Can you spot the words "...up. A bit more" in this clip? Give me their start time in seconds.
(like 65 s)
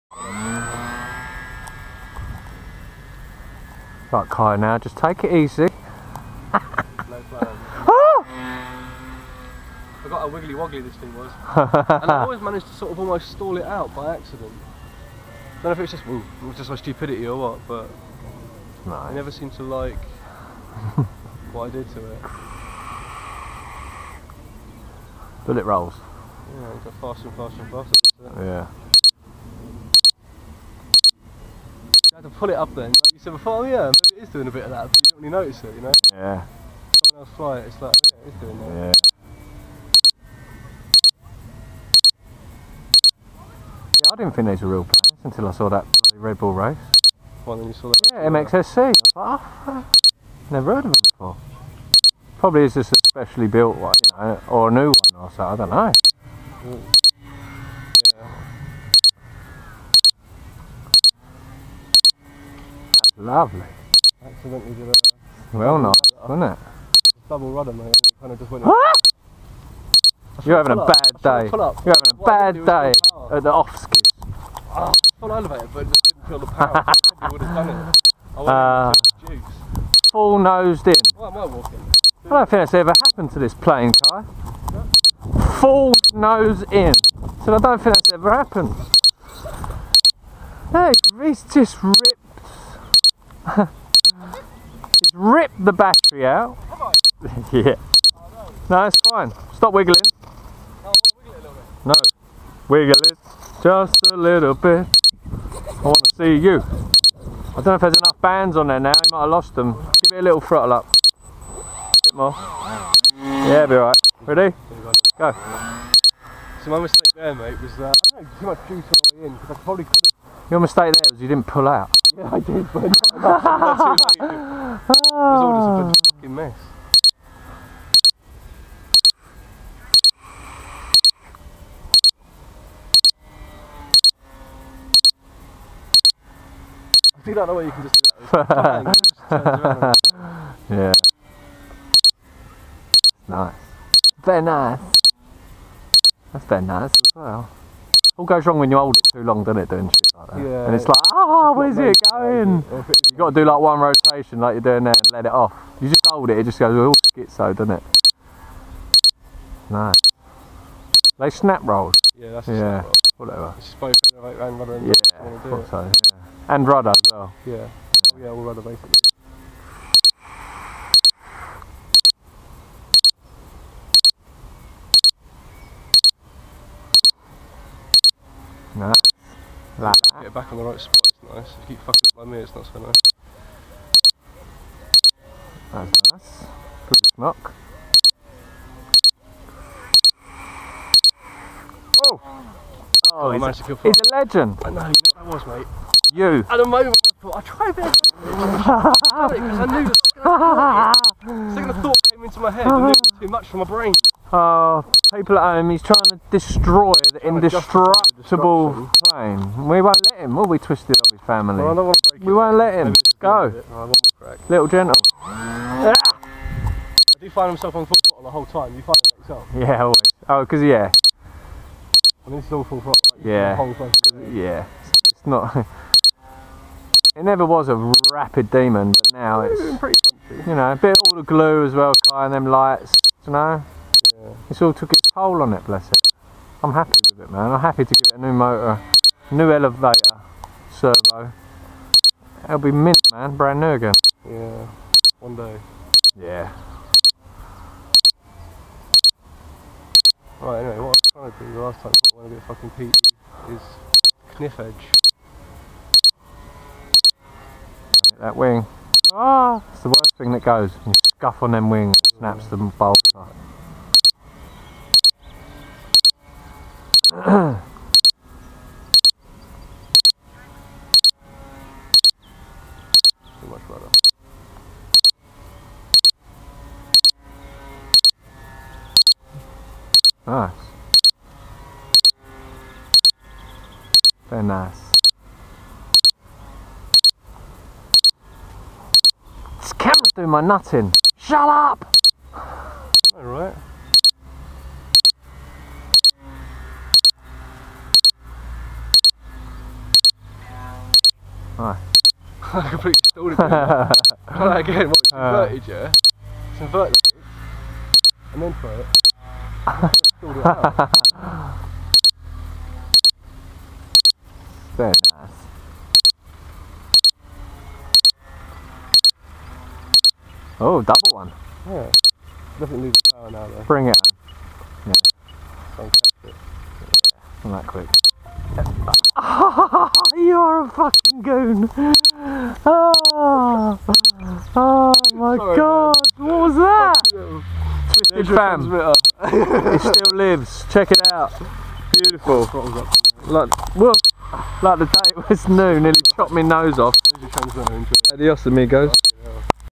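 110 s.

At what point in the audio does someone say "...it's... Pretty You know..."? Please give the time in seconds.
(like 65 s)
229 s.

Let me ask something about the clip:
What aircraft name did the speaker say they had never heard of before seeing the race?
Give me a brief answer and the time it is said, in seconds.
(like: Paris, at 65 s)
MXSC, at 48 s.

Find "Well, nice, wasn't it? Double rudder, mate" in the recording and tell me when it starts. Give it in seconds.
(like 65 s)
65 s.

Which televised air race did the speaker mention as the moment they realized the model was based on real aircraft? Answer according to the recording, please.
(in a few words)
Red Bull race.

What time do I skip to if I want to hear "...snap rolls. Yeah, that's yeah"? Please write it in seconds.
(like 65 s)
161 s.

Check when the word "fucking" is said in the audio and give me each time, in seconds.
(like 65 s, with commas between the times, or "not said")
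126 s, 181 s, 252 s, 330 s.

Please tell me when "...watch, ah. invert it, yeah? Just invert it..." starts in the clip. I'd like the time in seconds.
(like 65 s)
304 s.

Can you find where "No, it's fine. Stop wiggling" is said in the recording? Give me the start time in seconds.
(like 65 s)
98 s.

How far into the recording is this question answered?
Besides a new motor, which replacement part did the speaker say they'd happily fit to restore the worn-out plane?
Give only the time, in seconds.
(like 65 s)
239 s.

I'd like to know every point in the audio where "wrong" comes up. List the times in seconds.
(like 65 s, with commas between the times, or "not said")
148 s.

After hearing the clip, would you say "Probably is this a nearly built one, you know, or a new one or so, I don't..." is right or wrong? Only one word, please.
wrong.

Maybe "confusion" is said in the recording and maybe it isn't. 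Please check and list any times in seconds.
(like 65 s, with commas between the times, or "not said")
not said.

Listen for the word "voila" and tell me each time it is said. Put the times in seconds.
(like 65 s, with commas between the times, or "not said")
not said.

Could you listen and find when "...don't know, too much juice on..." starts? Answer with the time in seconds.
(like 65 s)
118 s.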